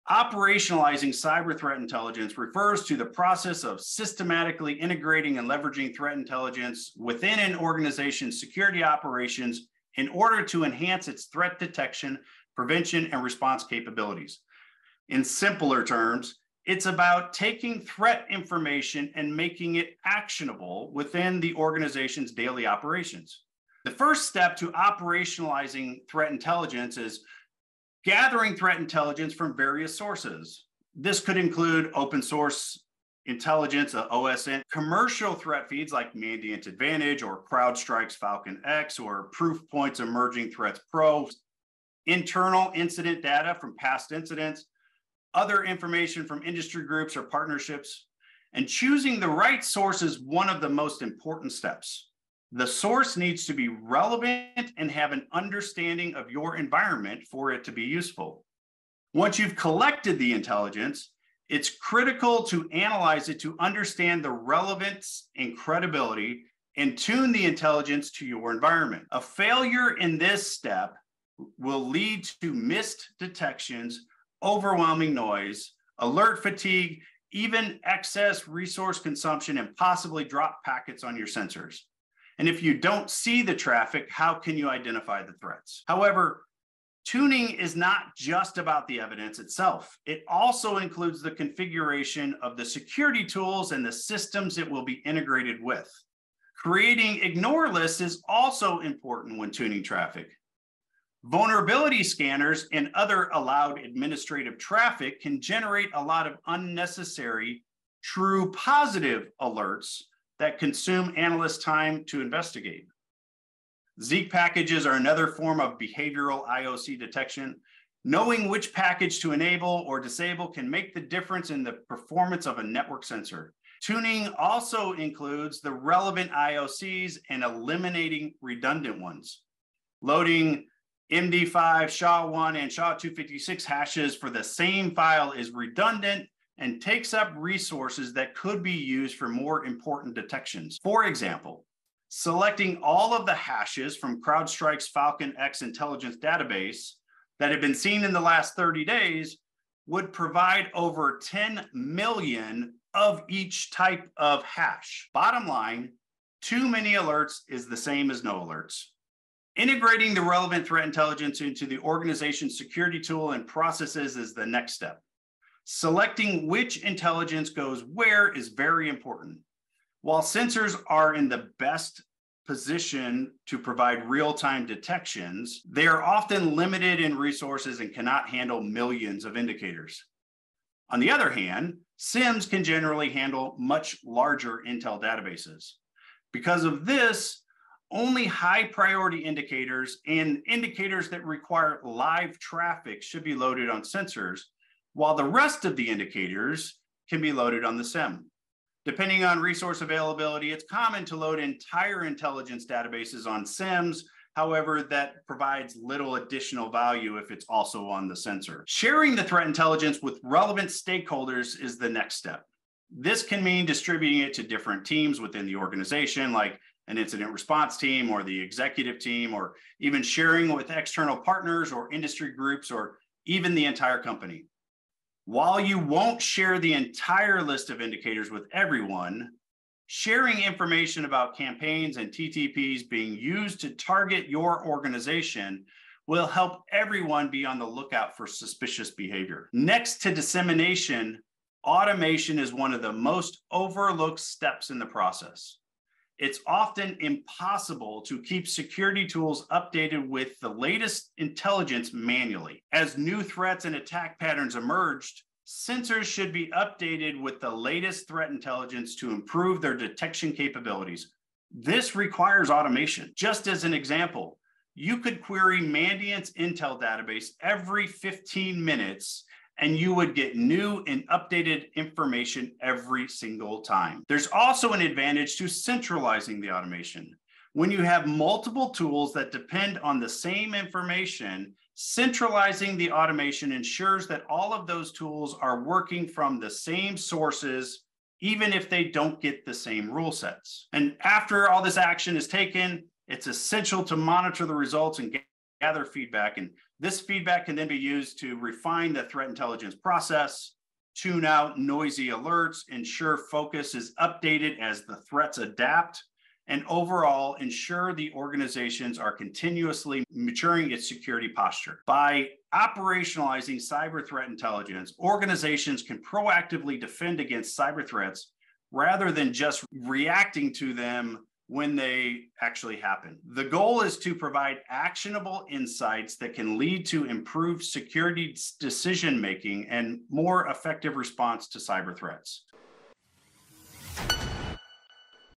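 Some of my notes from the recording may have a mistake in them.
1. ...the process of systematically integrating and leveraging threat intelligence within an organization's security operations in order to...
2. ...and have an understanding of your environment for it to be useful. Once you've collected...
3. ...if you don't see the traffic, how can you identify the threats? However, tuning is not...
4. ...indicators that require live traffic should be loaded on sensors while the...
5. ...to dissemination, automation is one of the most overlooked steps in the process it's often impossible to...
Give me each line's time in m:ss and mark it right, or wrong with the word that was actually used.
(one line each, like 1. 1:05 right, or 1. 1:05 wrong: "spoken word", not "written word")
1. 0:02 right
2. 0:54 right
3. 1:22 right
4. 3:10 right
5. 4:00 right.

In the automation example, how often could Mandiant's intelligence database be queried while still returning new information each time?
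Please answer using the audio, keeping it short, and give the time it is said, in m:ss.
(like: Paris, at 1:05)
every 15 minutes, at 4:27.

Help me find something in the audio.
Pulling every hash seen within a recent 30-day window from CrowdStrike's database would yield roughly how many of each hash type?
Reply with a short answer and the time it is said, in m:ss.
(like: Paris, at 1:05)
over 10 million, at 2:30.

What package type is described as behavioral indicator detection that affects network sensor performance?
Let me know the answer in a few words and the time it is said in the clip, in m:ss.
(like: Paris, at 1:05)
Zeek, at 1:54.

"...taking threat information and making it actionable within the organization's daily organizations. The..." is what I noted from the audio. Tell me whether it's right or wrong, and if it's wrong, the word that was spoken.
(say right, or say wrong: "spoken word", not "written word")
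wrong: "operations", not "organizations".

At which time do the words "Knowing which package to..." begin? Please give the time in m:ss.
1:58.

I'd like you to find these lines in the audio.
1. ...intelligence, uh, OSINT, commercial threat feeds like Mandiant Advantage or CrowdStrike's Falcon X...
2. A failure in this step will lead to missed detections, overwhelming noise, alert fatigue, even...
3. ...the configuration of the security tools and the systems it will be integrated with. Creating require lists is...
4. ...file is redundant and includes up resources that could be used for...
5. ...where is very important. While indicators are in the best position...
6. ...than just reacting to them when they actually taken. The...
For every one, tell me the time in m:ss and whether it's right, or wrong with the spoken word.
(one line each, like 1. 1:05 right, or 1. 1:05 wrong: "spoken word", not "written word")
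1. 0:33 right
2. 1:09 right
3. 1:31 wrong: "ignore", not "require"
4. 2:14 wrong: "takes", not "includes"
5. 2:47 wrong: "sensors", not "indicators"
6. 5:19 wrong: "happen", not "taken".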